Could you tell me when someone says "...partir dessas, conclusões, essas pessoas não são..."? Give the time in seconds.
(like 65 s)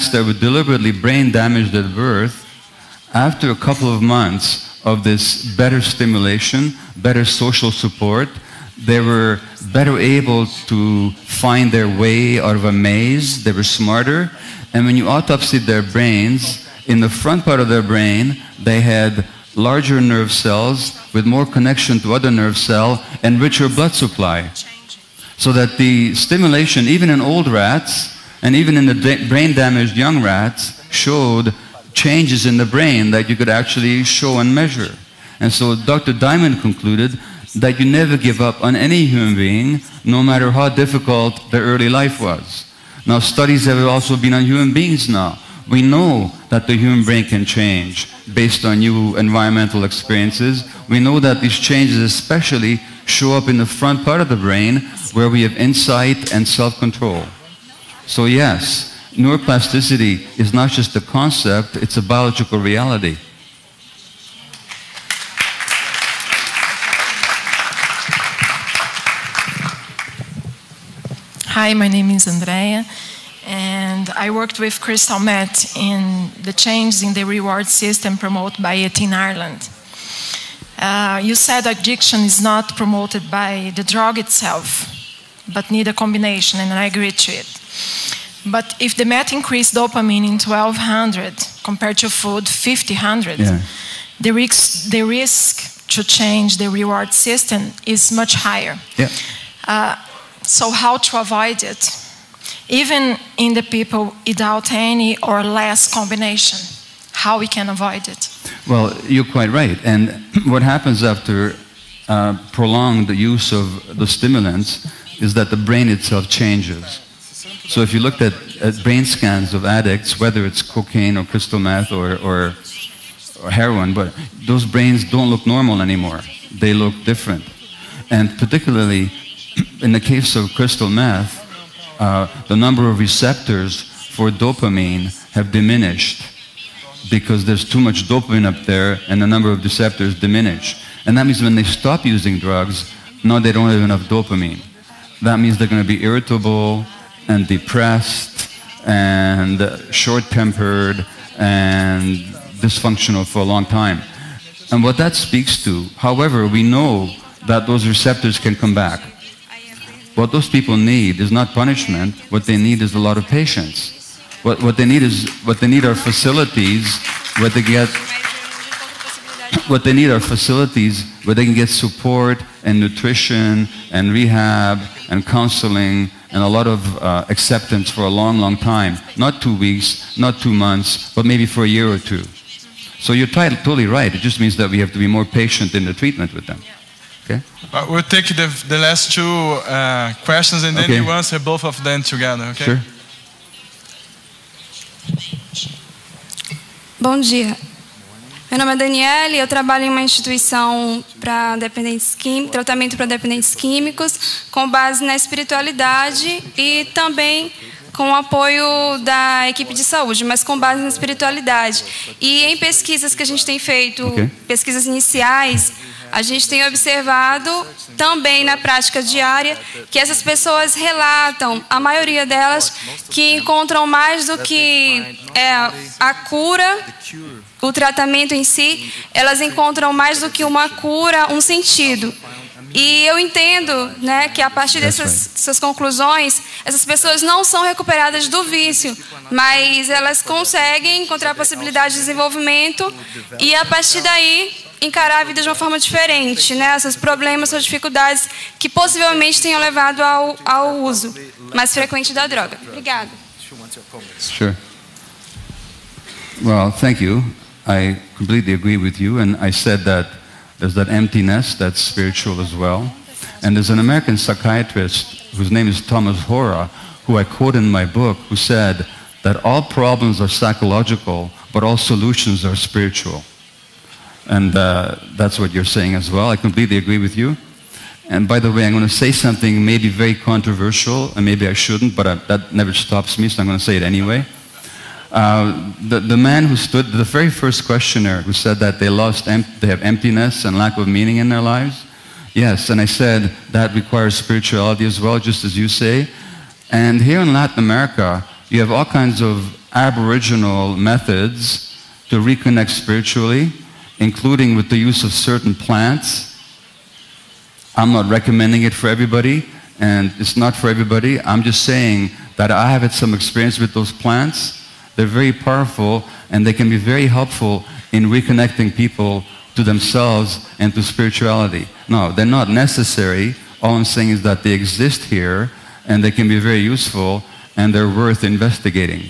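234 s.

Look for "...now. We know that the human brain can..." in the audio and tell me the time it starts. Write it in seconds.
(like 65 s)
45 s.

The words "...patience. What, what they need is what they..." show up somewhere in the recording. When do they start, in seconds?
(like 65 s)
163 s.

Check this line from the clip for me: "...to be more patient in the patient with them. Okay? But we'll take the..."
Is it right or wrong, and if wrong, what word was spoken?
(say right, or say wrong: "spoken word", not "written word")
wrong: "treatment", not "patient".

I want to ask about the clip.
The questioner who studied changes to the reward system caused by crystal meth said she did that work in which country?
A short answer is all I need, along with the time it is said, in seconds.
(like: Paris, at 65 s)
Ireland, at 79 s.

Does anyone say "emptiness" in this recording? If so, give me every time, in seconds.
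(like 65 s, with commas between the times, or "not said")
260 s, 289 s.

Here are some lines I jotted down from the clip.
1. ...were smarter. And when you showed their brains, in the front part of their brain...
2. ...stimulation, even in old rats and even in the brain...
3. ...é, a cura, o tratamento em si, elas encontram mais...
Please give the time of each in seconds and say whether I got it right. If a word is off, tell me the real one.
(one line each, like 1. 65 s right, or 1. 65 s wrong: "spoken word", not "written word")
1. 13 s wrong: "autopsied", not "showed"
2. 26 s right
3. 225 s right.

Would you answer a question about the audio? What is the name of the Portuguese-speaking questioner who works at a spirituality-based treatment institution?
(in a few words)
Daniele.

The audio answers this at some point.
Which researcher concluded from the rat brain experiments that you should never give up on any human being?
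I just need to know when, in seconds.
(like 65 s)
35 s.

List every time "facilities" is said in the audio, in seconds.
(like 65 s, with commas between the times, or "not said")
165 s, 170 s.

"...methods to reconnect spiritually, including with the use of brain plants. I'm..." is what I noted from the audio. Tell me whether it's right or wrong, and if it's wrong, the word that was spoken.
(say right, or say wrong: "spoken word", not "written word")
wrong: "certain", not "brain".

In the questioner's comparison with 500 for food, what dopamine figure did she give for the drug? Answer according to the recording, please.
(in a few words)
1200.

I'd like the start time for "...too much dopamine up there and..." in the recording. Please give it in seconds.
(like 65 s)
137 s.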